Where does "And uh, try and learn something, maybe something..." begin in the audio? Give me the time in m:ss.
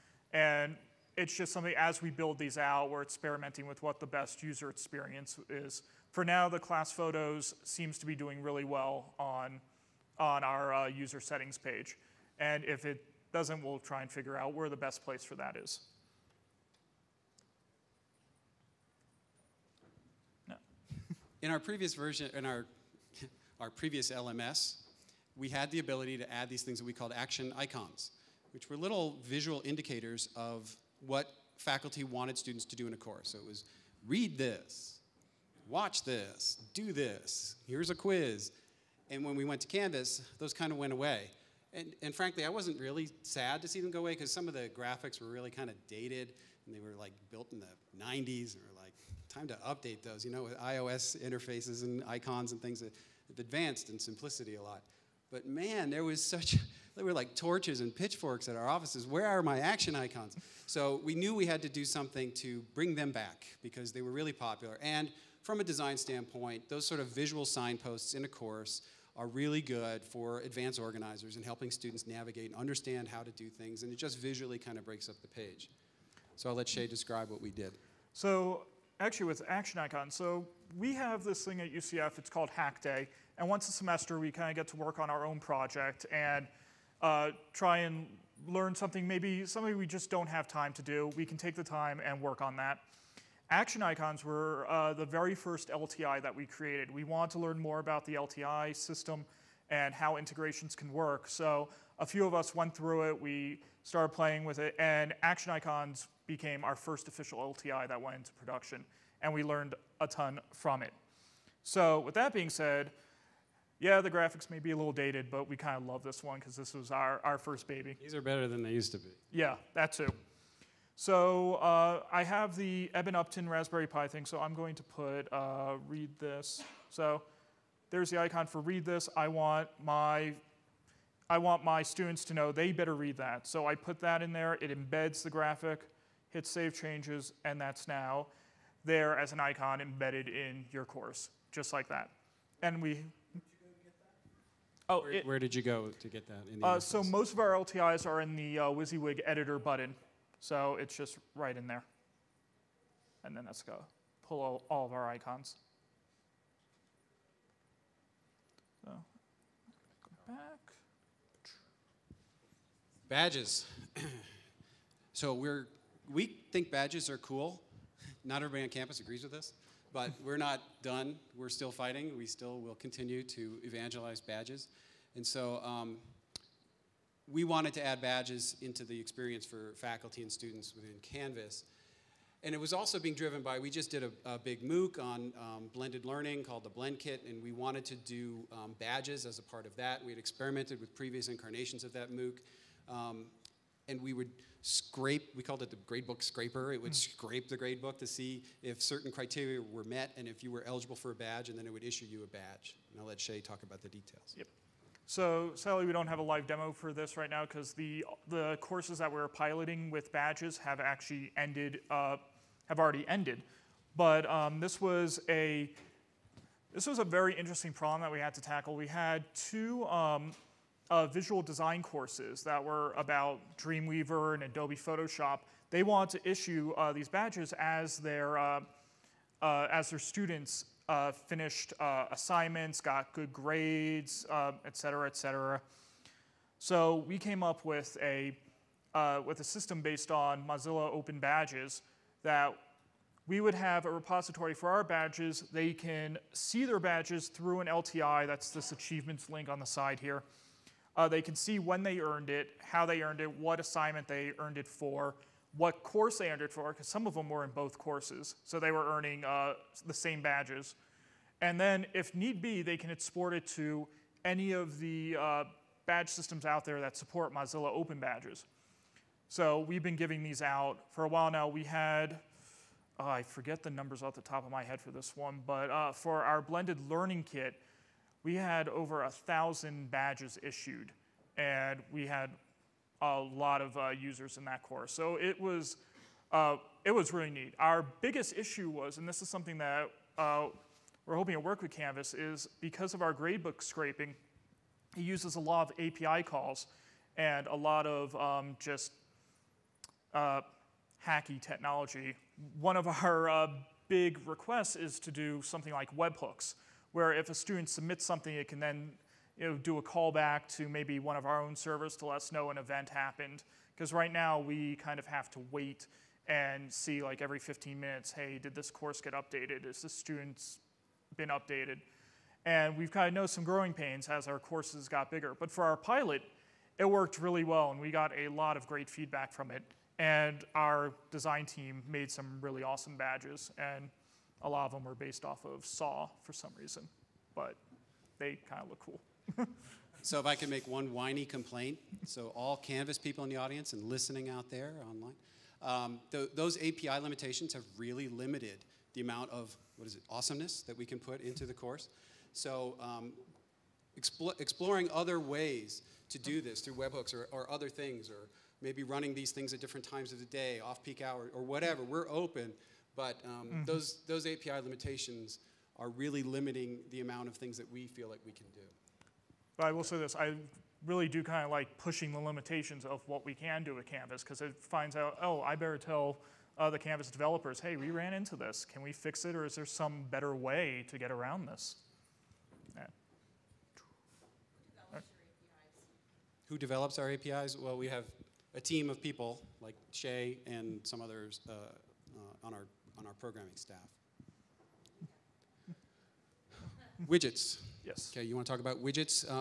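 1:26.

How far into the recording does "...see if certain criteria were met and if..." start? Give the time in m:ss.
3:18.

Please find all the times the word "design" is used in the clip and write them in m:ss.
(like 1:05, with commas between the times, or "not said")
1:05, 3:41, 5:31.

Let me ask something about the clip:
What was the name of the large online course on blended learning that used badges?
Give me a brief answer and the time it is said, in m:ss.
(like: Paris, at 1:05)
BlendKit, at 3:06.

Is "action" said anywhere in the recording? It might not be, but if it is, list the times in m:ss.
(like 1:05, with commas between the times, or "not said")
0:27, 0:59, 1:19, 1:33, 1:45.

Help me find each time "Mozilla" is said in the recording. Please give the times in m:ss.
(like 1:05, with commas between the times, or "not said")
4:00, 4:27.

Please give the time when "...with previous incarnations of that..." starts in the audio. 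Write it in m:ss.
3:10.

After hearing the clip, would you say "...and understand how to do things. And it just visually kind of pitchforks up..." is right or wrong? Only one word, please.
wrong.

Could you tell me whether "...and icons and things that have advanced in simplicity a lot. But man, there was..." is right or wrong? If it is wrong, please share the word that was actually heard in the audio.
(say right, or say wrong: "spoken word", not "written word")
right.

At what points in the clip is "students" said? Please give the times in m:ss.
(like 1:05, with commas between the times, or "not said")
0:32, 1:11, 2:11, 3:00, 3:49, 5:07, 5:19.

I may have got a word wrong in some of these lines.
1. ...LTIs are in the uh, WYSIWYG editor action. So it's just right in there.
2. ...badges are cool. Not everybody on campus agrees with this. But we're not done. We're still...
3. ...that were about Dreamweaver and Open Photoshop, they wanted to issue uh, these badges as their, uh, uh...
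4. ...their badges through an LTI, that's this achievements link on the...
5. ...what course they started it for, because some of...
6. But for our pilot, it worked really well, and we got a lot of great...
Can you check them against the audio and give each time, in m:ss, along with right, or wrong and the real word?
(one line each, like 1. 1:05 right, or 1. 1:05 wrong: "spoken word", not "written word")
1. 2:27 wrong: "button", not "action"
2. 2:46 right
3. 3:42 wrong: "Adobe", not "Open"
4. 4:06 right
5. 4:15 wrong: "earned", not "started"
6. 5:25 right.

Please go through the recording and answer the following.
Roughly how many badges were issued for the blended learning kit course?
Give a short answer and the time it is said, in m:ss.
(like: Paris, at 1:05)
over 1000, at 4:38.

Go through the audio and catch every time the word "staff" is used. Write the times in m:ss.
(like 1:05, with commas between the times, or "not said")
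6:33.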